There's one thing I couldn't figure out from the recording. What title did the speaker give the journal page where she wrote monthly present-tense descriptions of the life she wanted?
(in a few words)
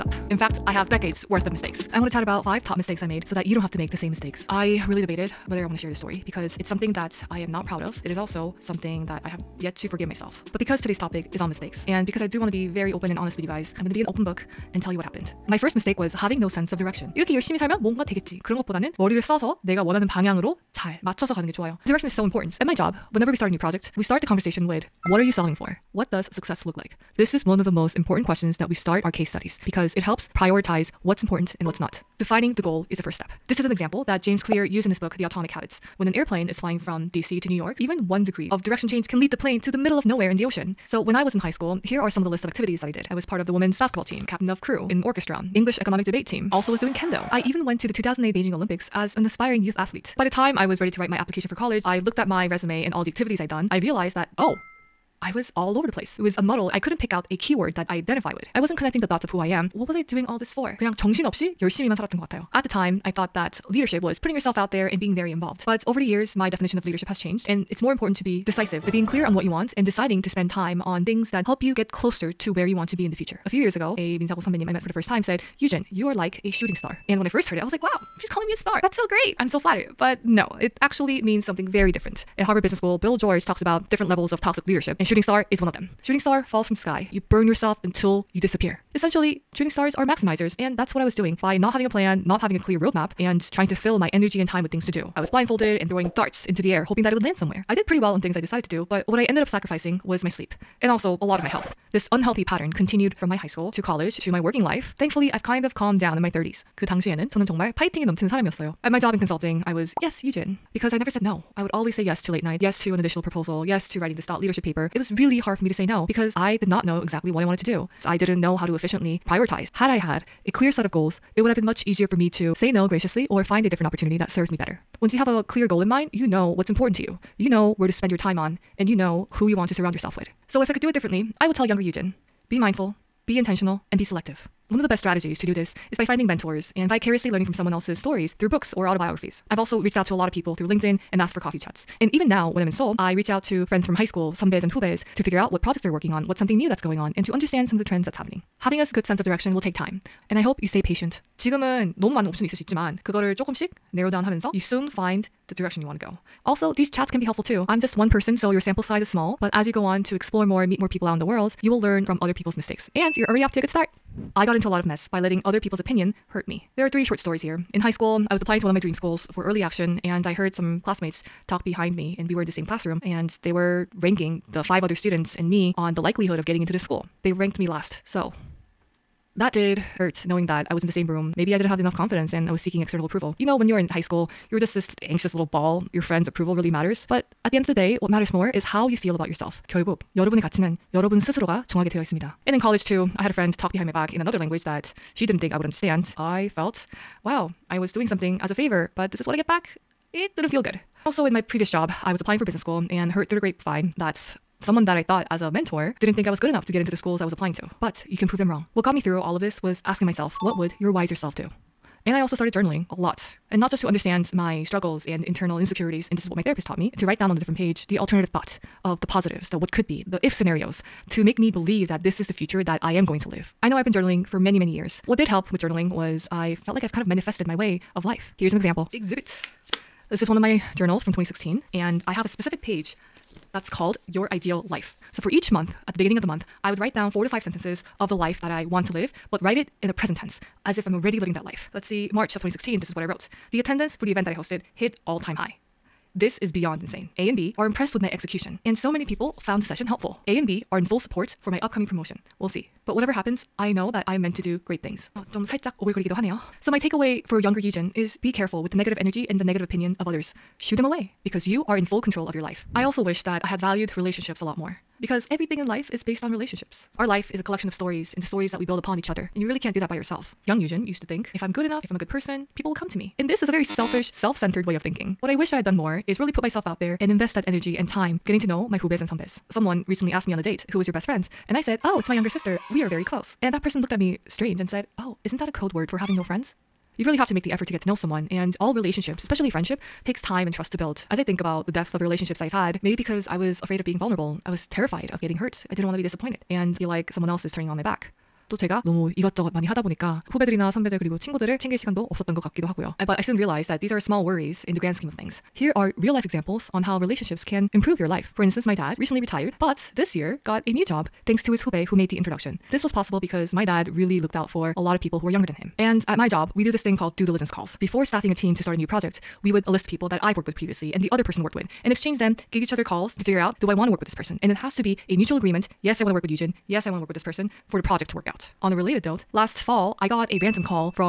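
Your Ideal Life.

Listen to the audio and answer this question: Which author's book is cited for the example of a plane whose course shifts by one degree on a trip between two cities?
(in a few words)
James Clear.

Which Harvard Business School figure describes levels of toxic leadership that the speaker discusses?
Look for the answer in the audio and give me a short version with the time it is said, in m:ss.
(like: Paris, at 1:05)
Bill George, at 1:22.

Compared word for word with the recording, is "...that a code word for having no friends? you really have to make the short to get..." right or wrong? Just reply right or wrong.
wrong.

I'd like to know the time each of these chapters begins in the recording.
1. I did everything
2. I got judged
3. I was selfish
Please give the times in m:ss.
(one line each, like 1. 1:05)
1. 0:15
2. 2:43
3. 4:22.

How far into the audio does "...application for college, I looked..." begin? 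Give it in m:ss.
0:51.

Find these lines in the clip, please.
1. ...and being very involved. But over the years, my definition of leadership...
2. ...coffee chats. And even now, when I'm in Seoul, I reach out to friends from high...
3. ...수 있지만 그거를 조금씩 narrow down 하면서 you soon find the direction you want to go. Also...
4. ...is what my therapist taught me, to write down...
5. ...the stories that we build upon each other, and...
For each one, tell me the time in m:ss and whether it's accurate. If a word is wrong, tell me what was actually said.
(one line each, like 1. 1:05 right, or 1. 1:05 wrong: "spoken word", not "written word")
1. 1:04 right
2. 2:21 right
3. 2:32 right
4. 3:36 right
5. 4:28 right.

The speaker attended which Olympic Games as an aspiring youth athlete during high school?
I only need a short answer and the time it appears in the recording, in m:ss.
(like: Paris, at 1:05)
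2008 Beijing Olympics, at 0:47.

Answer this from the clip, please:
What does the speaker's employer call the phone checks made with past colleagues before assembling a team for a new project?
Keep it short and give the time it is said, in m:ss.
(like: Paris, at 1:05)
due diligence calls, at 5:17.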